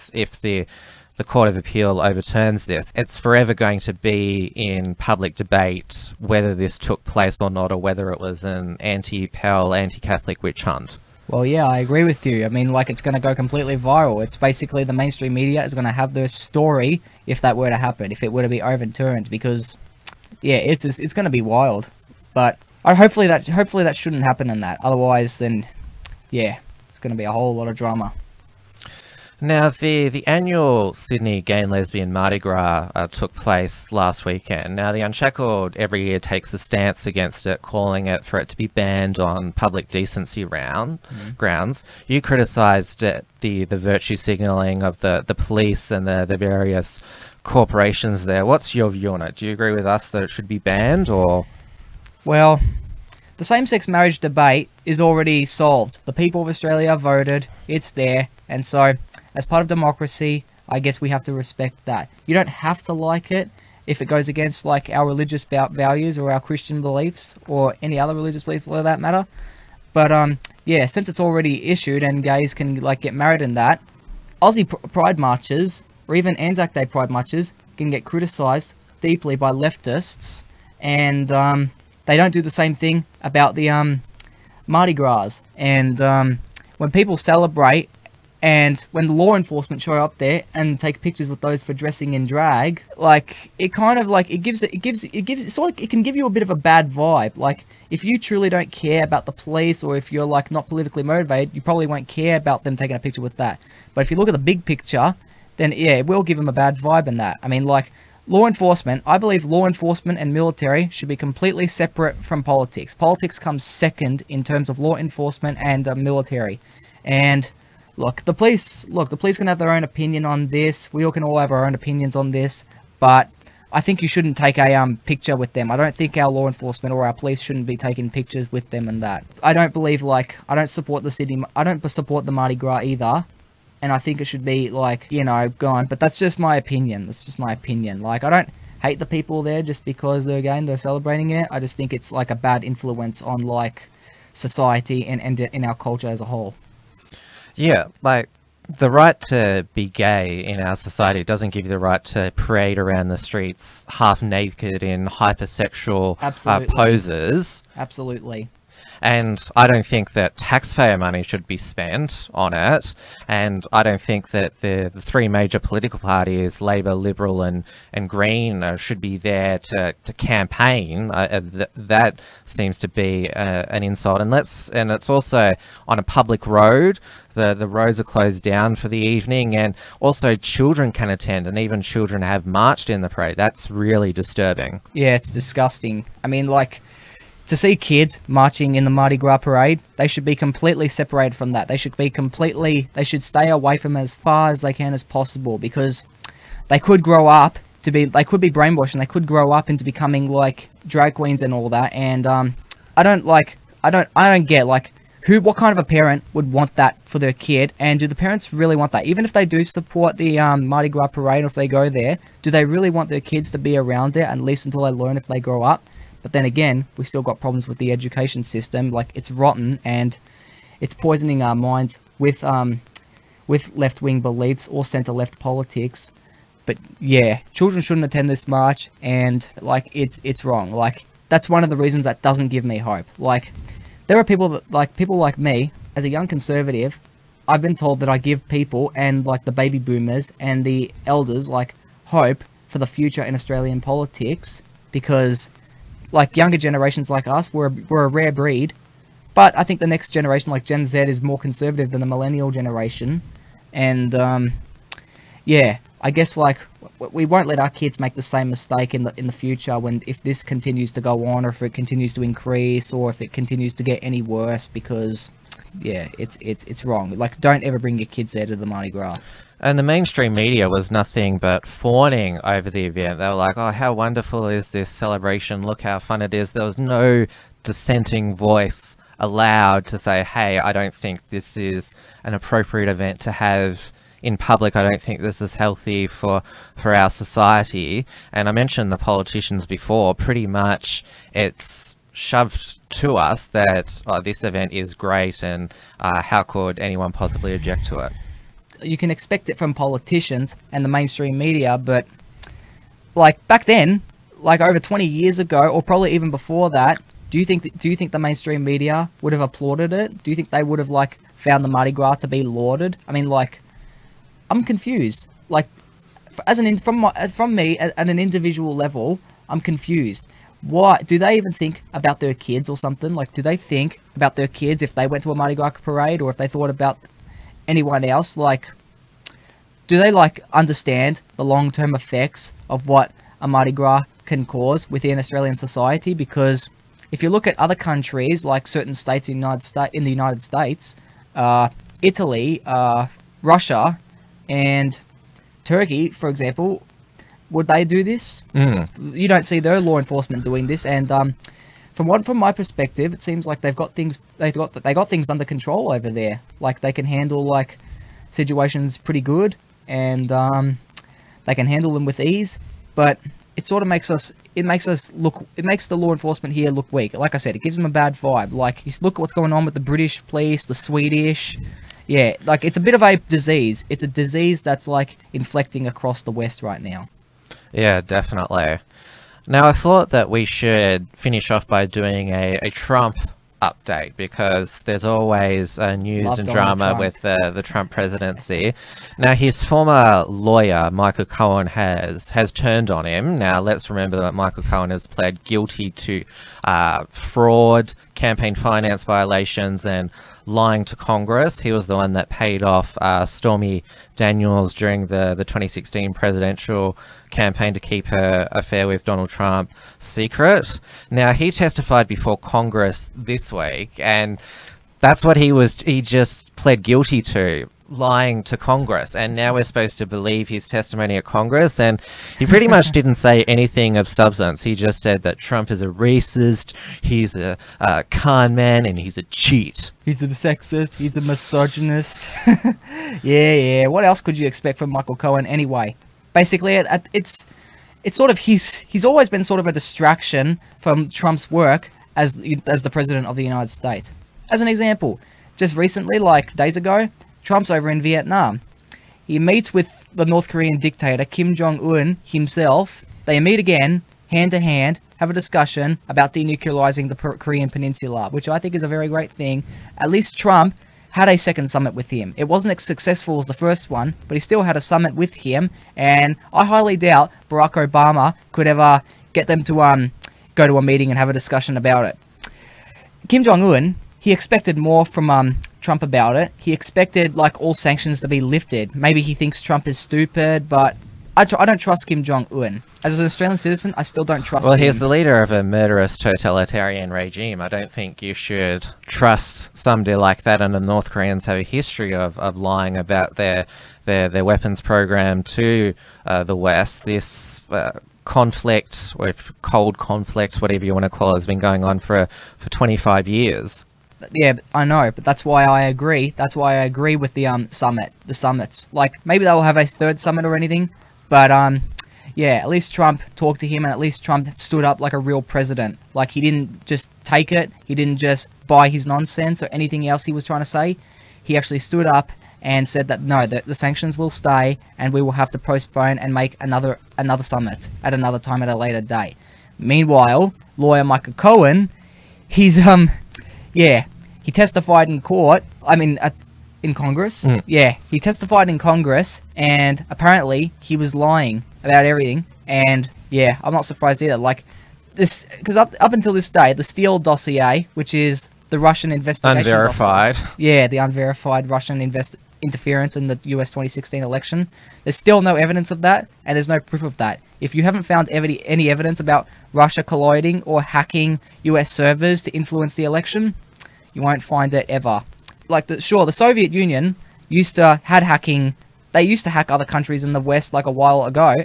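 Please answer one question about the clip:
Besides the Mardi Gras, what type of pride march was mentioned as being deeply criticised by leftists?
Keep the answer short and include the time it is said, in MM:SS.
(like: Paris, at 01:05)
Anzac Day pride marches, at 01:16.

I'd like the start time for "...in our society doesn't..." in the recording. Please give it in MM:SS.
02:30.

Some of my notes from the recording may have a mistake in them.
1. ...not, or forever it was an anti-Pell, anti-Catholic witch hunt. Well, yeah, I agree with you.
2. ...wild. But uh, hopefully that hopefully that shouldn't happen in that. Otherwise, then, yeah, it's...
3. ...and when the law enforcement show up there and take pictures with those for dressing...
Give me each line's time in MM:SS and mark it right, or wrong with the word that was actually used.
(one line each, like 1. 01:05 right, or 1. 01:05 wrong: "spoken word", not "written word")
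1. 00:07 wrong: "whether", not "forever"
2. 00:21 right
3. 01:28 right.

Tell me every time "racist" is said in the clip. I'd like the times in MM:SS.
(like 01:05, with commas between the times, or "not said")
07:05.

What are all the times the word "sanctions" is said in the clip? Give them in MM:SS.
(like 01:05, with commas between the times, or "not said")
07:57, 08:43.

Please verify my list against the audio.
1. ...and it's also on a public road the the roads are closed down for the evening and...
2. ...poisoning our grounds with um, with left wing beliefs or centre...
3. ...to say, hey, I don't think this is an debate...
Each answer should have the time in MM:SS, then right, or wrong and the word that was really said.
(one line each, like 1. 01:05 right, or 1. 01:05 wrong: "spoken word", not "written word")
1. 02:54 right
2. 03:40 wrong: "minds", not "grounds"
3. 04:39 wrong: "appropriate", not "debate".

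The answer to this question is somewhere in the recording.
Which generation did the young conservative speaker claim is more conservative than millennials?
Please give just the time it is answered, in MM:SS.
04:10.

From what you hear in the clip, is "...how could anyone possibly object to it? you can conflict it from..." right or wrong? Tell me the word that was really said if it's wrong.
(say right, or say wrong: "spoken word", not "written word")
wrong: "expect", not "conflict".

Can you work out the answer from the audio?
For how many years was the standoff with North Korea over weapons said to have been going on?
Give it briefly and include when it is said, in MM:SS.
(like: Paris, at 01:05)
25, at 08:22.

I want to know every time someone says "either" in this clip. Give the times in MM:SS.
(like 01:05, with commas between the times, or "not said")
02:12, 09:04.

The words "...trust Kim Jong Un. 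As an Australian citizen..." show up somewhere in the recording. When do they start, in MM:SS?
08:01.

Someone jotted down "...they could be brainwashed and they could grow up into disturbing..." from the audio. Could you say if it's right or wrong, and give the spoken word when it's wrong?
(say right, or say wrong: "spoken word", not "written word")
wrong: "becoming", not "disturbing".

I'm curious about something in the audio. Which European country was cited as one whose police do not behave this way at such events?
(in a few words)
Italy.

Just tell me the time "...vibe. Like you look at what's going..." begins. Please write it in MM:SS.
06:08.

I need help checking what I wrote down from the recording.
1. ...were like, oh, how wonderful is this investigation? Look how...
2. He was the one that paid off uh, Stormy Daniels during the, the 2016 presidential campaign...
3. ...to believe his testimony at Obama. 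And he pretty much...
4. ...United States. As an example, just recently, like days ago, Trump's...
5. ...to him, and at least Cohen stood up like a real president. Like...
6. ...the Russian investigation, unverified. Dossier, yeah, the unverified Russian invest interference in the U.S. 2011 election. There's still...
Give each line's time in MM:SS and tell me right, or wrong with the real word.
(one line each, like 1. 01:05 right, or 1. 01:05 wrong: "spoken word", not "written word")
1. 04:33 wrong: "celebration", not "investigation"
2. 06:41 right
3. 06:59 wrong: "Congress", not "Obama"
4. 07:23 right
5. 08:33 wrong: "Trump", not "Cohen"
6. 09:08 wrong: "2016", not "2011".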